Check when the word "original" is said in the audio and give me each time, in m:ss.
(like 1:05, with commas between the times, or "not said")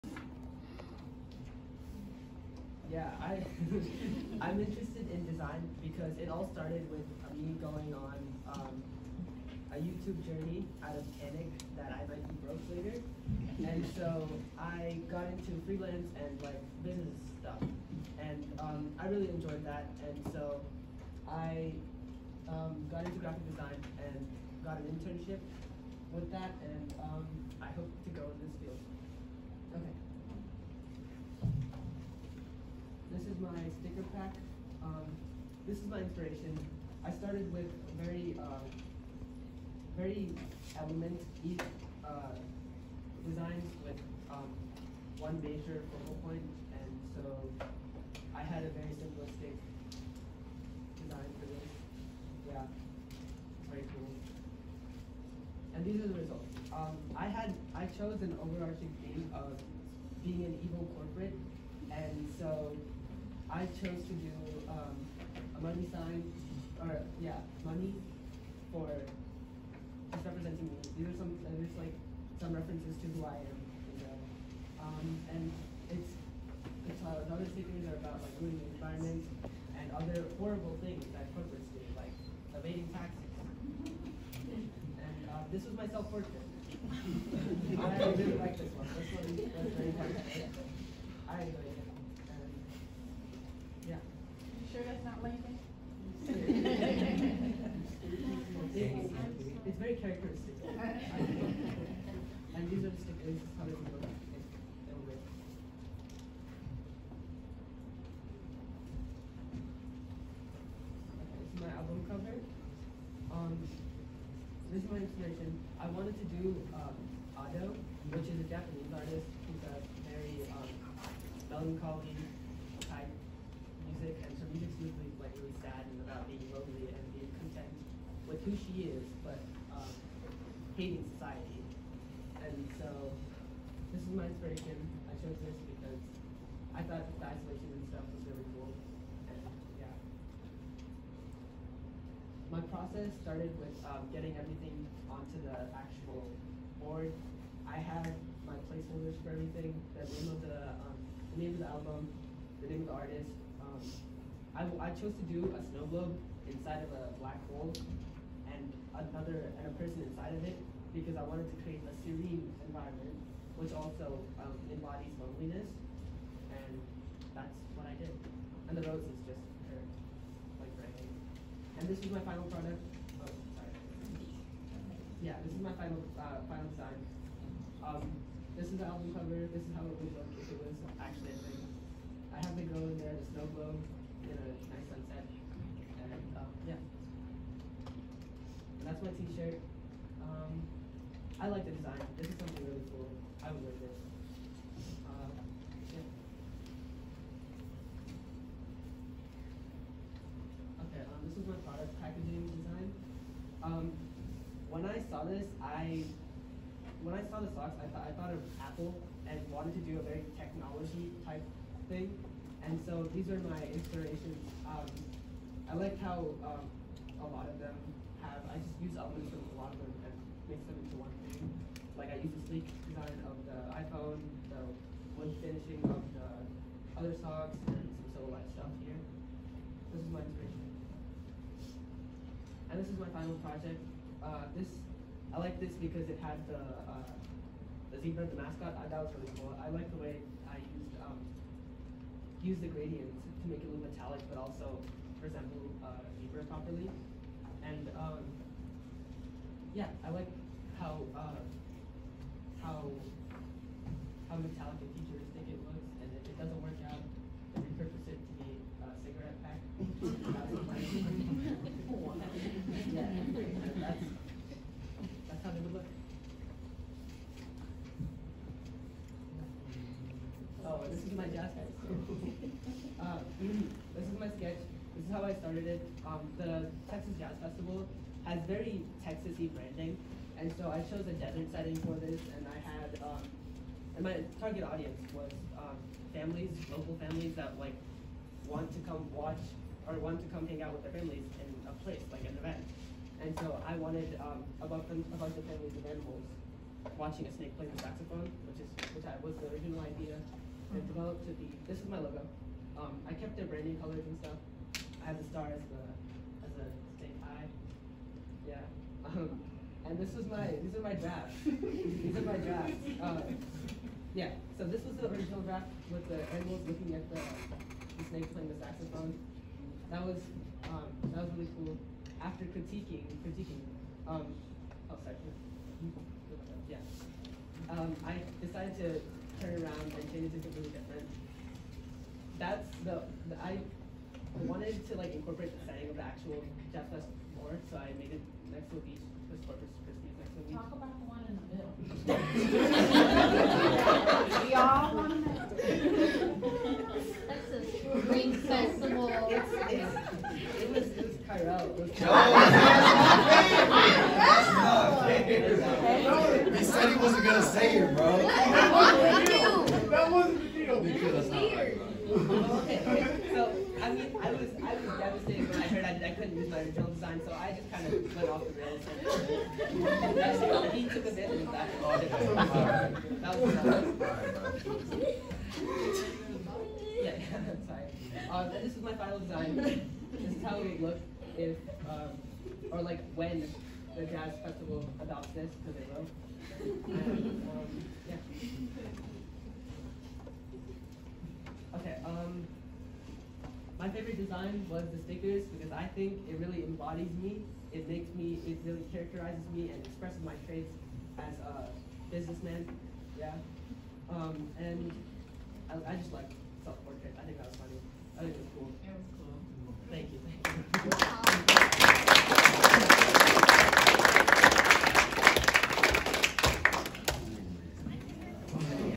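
4:59, 5:15, 6:06.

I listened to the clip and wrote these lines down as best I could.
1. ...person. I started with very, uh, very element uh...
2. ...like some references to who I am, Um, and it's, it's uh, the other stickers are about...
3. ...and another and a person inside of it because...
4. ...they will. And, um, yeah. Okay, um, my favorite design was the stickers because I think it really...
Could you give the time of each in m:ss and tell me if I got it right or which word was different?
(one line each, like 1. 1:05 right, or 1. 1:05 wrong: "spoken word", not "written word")
1. 0:35 wrong: "inspiration", not "person"
2. 1:11 right
3. 2:38 right
4. 6:25 right.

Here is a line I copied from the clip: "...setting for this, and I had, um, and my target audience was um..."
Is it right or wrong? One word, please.
right.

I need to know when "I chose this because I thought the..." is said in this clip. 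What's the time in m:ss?
2:15.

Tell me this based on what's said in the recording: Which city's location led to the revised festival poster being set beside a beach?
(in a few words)
Corpus Christi.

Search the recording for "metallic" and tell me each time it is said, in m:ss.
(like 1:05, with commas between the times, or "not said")
4:03, 4:14.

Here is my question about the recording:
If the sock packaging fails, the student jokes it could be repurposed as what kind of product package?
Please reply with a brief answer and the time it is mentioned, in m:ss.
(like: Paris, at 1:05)
Cigarette pack, at 4:19.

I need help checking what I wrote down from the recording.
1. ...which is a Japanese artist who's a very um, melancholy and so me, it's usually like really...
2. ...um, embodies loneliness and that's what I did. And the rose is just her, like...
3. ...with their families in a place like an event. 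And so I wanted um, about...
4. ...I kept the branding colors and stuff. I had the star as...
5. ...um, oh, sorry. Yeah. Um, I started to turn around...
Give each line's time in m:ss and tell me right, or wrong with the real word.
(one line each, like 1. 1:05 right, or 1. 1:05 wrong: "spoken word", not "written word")
1. 1:58 right
2. 2:44 right
3. 4:50 right
4. 5:03 right
5. 5:24 wrong: "decided", not "started".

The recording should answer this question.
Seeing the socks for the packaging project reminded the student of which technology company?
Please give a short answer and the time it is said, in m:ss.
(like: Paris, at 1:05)
Apple, at 3:28.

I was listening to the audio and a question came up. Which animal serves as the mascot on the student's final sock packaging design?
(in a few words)
Zebra.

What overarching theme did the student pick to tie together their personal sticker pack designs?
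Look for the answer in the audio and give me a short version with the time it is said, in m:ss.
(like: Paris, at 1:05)
Evil corporate, at 1:00.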